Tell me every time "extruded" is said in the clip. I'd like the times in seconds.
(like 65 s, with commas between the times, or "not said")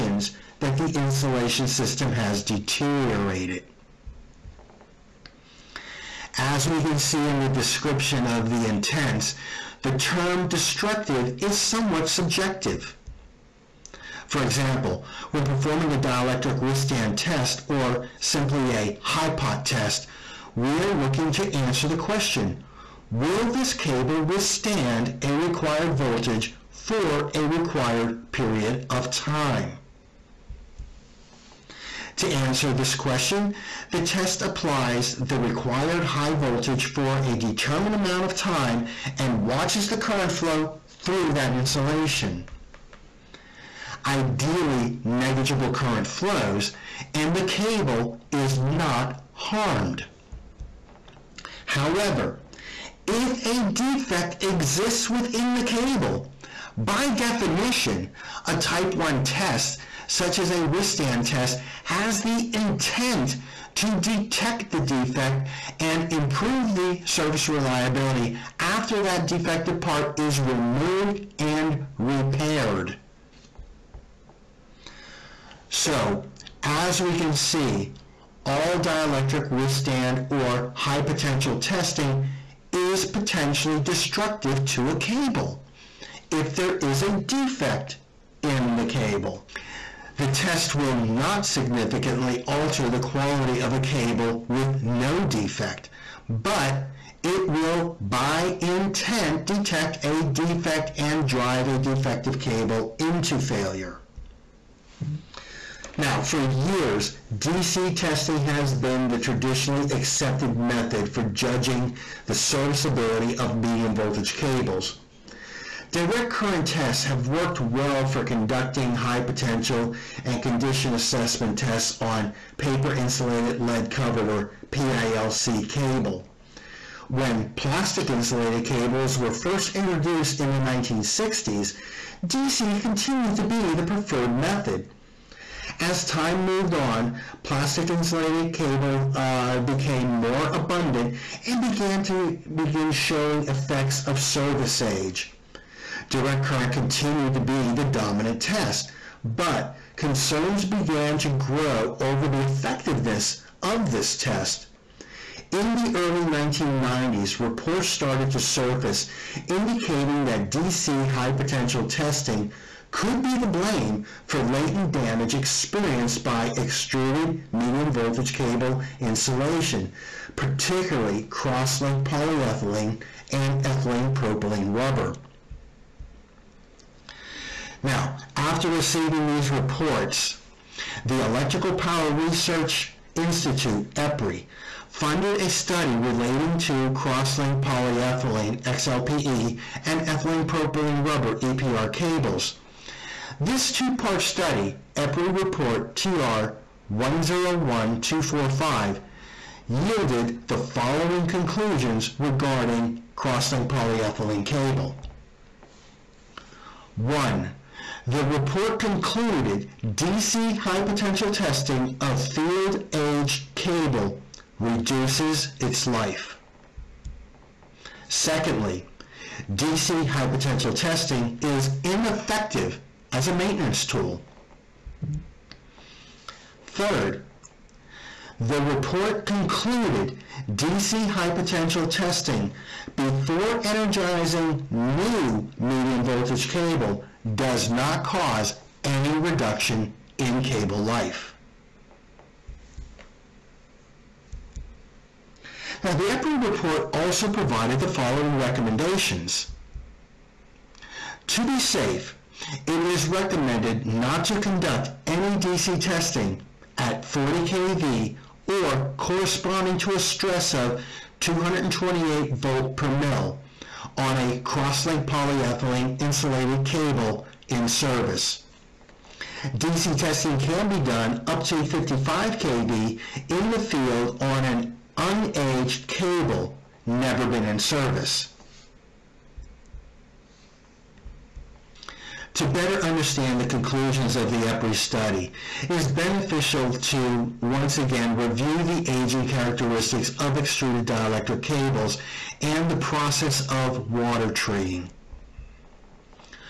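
166 s, 290 s.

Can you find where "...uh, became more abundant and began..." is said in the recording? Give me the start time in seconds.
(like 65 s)
139 s.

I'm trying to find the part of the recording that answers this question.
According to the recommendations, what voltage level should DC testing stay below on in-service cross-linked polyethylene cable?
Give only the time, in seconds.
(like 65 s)
257 s.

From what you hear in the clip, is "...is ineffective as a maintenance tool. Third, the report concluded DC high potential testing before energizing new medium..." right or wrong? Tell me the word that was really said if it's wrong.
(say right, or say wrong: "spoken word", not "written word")
right.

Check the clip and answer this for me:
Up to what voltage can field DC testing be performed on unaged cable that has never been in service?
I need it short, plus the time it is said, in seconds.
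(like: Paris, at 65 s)
55 kV, at 271 s.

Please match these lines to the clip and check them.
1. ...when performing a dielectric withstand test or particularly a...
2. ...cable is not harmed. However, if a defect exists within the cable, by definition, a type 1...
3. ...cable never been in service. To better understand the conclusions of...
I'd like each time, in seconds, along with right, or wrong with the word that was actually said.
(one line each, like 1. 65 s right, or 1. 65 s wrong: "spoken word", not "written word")
1. 15 s wrong: "simply", not "particularly"
2. 47 s right
3. 275 s right.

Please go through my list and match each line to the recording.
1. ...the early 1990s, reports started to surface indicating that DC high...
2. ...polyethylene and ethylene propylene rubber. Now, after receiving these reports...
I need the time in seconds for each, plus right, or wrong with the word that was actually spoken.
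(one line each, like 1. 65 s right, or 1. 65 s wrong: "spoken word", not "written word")
1. 155 s right
2. 172 s right.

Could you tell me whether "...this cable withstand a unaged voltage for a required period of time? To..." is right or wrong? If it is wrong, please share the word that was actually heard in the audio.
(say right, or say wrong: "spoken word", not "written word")
wrong: "required", not "unaged".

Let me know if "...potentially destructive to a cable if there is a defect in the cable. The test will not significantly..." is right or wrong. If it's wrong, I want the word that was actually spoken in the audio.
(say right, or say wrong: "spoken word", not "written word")
right.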